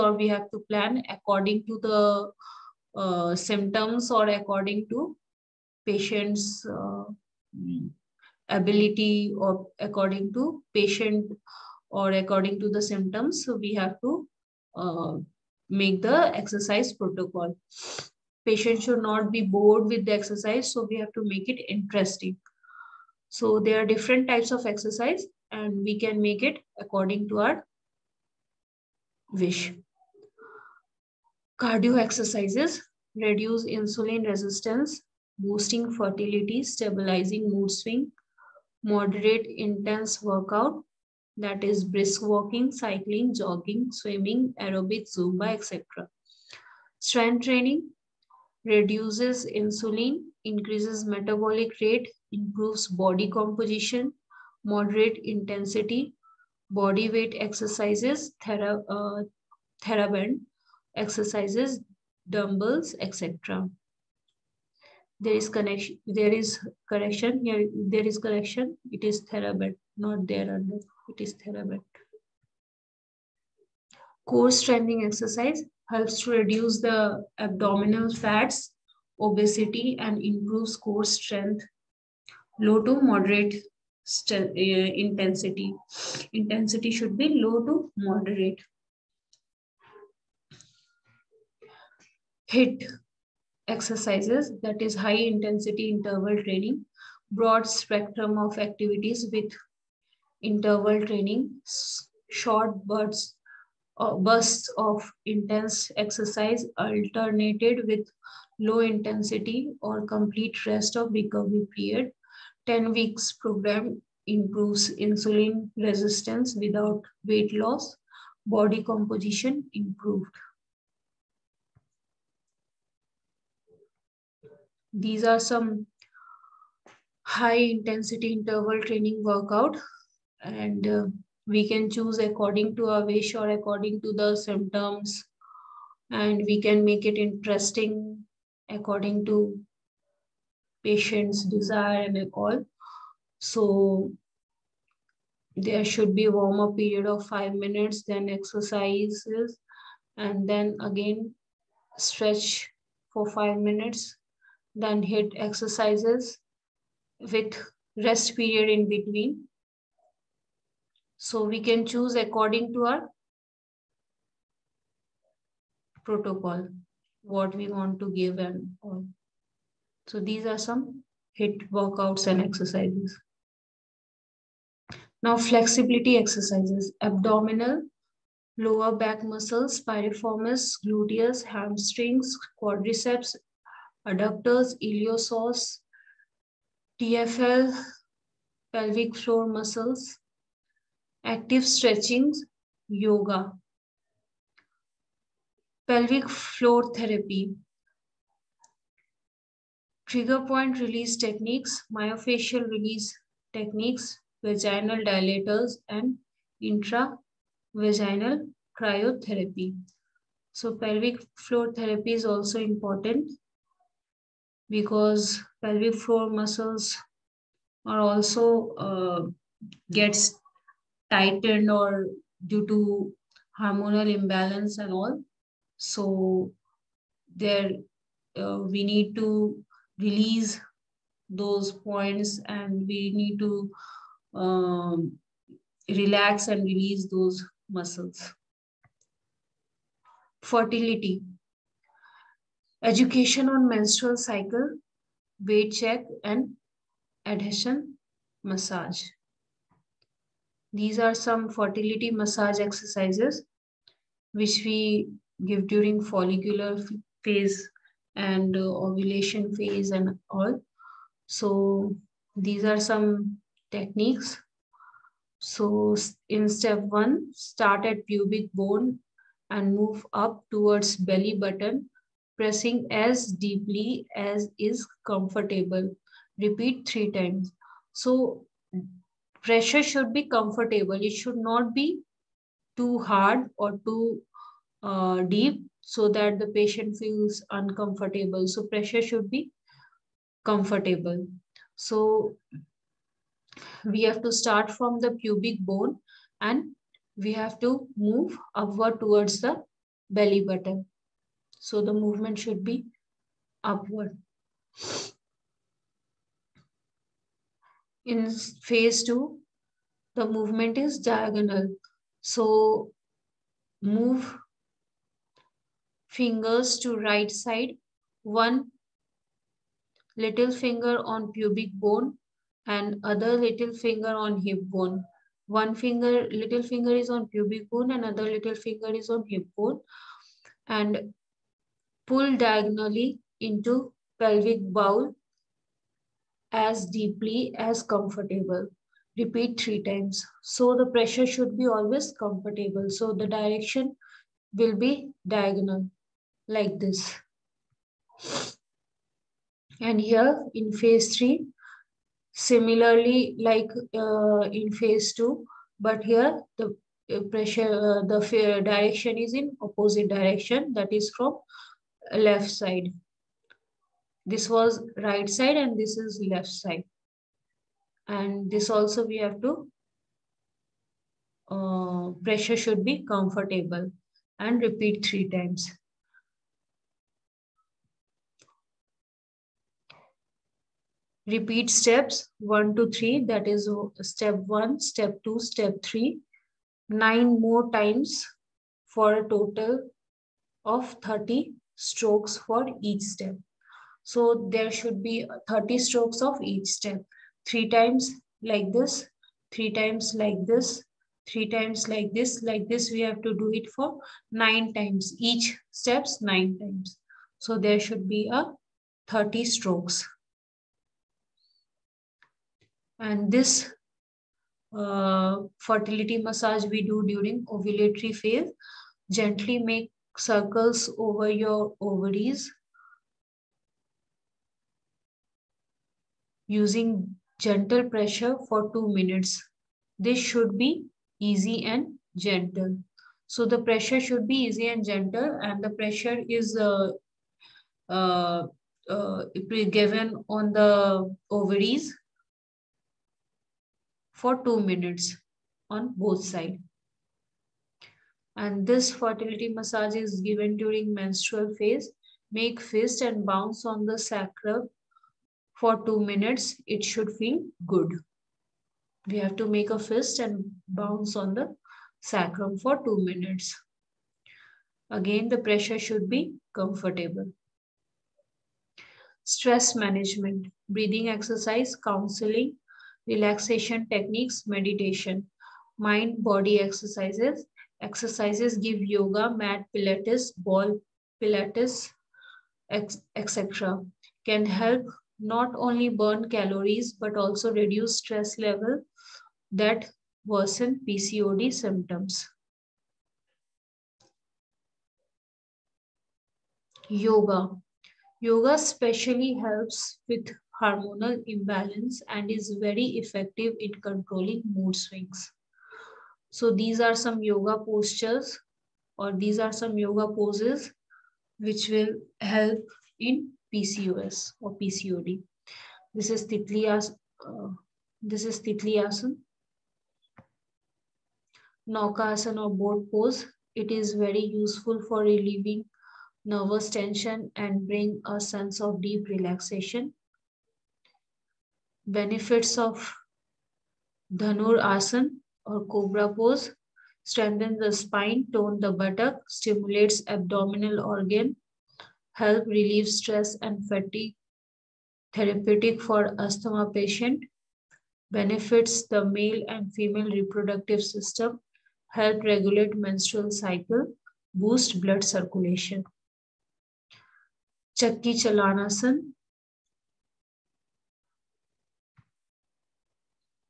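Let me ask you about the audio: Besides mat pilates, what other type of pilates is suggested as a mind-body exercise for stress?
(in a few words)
ball pilates.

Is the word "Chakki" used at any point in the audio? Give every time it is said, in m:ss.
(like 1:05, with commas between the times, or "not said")
9:17.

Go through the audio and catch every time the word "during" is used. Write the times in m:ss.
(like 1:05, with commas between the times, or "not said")
4:15, 6:57, 7:30.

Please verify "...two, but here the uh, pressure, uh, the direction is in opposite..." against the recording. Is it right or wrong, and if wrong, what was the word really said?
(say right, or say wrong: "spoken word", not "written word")
right.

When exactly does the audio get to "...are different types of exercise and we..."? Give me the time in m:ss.
0:23.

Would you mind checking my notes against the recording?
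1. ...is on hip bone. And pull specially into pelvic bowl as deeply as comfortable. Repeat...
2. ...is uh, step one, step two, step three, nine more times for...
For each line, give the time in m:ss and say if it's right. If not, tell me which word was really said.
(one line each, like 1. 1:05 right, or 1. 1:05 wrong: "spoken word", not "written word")
1. 5:28 wrong: "diagonally", not "specially"
2. 6:23 right.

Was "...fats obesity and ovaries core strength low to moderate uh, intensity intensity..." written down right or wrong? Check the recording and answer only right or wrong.
wrong.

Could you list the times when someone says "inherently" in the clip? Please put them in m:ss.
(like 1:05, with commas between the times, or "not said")
not said.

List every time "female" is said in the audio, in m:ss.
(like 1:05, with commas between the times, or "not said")
9:09.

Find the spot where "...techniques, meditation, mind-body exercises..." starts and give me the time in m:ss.
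7:53.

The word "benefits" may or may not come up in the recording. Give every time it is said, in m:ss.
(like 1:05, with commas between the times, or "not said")
8:51, 9:08.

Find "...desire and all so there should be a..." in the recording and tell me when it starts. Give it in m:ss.
2:21.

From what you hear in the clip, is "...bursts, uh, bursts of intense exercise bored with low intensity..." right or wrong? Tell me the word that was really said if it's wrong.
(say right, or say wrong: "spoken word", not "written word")
wrong: "alternated", not "bored".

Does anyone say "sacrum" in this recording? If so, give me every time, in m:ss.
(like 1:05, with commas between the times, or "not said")
7:33, 7:41.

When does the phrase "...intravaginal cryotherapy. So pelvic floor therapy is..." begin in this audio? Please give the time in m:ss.
3:26.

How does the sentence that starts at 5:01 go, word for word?
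So the movement should be upward.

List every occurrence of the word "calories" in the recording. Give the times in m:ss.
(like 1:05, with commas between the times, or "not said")
8:06.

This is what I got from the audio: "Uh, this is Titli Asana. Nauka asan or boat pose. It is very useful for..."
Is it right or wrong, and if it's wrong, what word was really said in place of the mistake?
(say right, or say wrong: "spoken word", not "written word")
right.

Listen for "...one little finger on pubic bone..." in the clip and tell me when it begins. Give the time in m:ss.
5:18.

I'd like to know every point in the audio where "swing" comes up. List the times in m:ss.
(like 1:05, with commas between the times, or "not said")
0:37, 8:24.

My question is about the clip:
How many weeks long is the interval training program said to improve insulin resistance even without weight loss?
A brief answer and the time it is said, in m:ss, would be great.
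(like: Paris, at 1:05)
10, at 1:52.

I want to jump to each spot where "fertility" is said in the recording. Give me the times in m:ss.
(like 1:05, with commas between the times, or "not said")
0:35, 4:00, 4:11, 6:55, 7:28.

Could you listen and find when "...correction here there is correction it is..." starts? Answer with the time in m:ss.
1:06.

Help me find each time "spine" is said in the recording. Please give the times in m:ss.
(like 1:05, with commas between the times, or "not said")
8:57.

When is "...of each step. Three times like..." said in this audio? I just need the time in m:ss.
6:36.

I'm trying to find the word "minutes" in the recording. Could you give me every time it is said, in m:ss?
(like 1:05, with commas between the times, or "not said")
2:27, 2:33, 7:08, 7:24, 7:35, 7:43.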